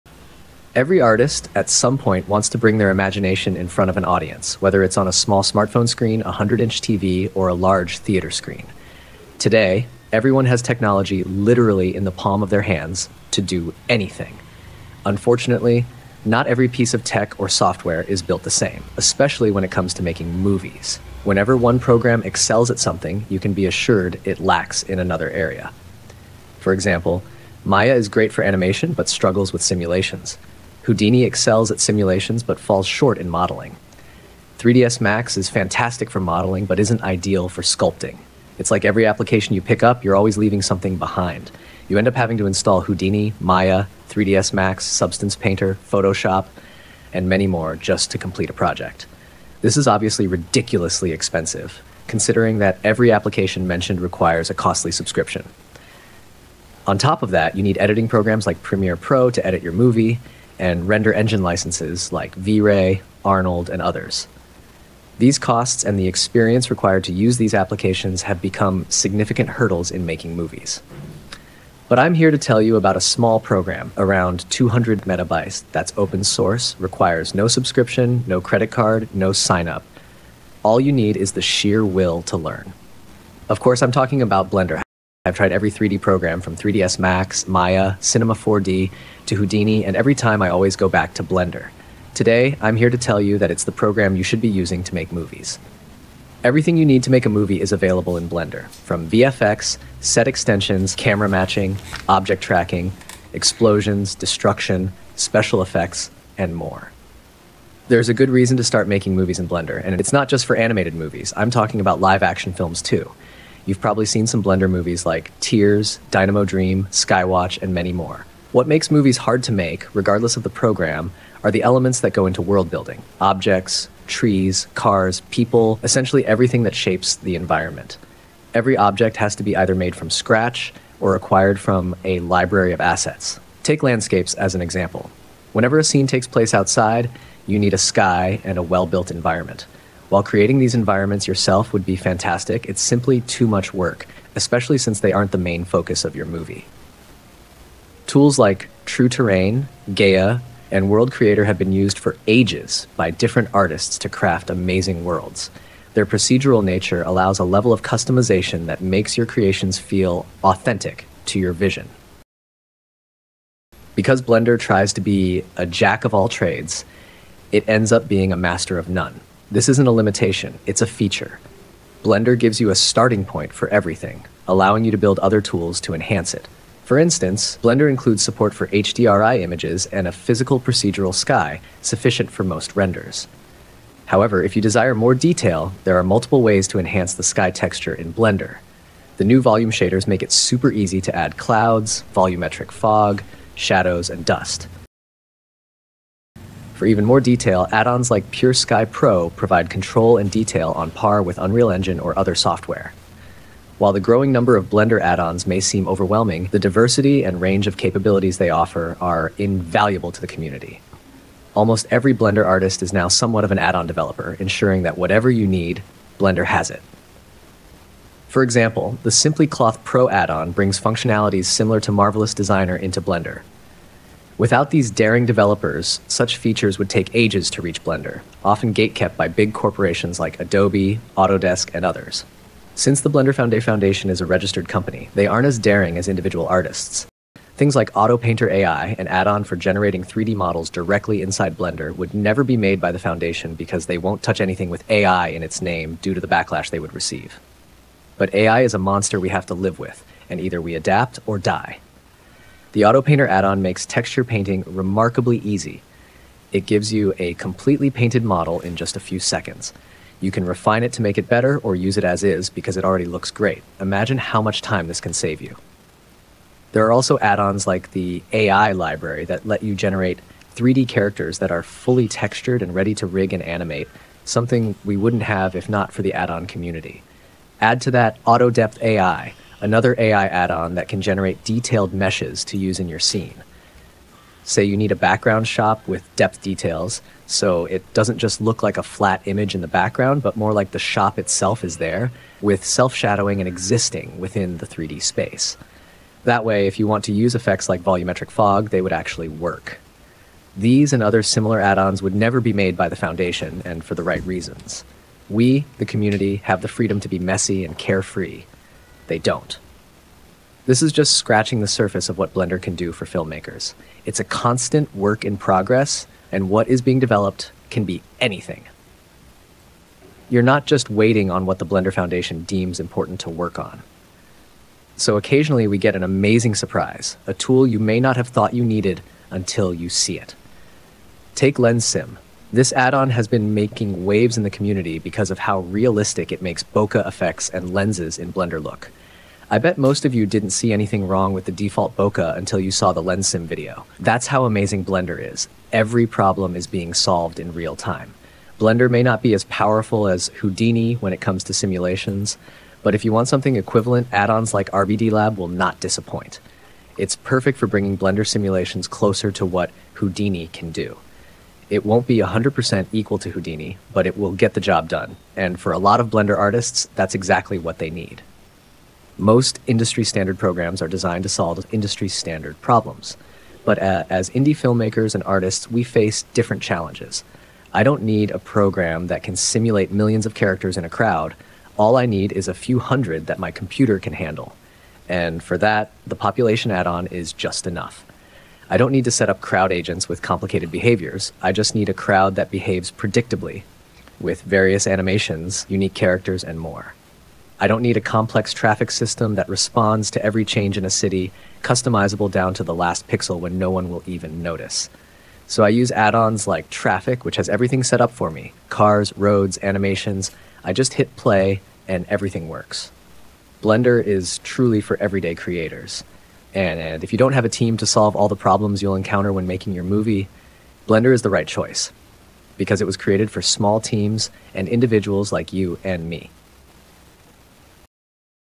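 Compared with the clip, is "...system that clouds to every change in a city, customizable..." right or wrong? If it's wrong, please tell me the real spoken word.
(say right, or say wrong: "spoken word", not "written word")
wrong: "responds", not "clouds".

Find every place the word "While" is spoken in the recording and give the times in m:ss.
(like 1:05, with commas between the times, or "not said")
2:20, 3:23.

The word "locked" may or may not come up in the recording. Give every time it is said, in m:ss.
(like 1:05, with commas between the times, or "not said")
not said.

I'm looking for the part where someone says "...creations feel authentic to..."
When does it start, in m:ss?
2:39.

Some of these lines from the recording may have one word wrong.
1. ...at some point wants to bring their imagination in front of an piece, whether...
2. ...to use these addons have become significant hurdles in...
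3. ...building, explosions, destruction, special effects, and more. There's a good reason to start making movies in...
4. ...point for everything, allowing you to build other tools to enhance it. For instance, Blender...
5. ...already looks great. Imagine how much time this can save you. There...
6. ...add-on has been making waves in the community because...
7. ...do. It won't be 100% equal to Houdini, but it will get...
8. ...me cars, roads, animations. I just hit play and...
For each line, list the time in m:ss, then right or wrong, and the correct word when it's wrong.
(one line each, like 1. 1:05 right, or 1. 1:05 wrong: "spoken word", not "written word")
1. 0:01 wrong: "audience", not "piece"
2. 1:07 wrong: "applications", not "addons"
3. 1:42 wrong: "tracking", not "building"
4. 2:53 right
5. 4:22 right
6. 5:32 right
7. 6:00 right
8. 6:48 right.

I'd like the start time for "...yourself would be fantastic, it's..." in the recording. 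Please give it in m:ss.
2:21.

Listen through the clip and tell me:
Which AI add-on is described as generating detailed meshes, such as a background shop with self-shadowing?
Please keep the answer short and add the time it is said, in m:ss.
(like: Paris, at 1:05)
Auto Depth AI, at 4:38.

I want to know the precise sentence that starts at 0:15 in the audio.
Unfortunately, not every piece of tech or software is built the same, especially when it comes to making movies.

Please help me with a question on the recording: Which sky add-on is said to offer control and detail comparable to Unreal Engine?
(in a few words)
Pure Sky Pro.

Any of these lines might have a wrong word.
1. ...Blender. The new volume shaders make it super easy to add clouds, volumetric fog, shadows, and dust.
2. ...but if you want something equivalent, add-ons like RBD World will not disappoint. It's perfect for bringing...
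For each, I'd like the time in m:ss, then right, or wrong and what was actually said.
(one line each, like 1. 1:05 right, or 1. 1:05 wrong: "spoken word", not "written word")
1. 3:08 right
2. 5:52 wrong: "Lab", not "World".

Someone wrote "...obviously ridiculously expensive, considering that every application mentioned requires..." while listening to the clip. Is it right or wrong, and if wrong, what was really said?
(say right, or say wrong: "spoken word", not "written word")
right.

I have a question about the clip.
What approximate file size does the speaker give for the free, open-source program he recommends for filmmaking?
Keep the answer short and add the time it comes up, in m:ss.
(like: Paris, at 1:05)
200 megabytes, at 1:14.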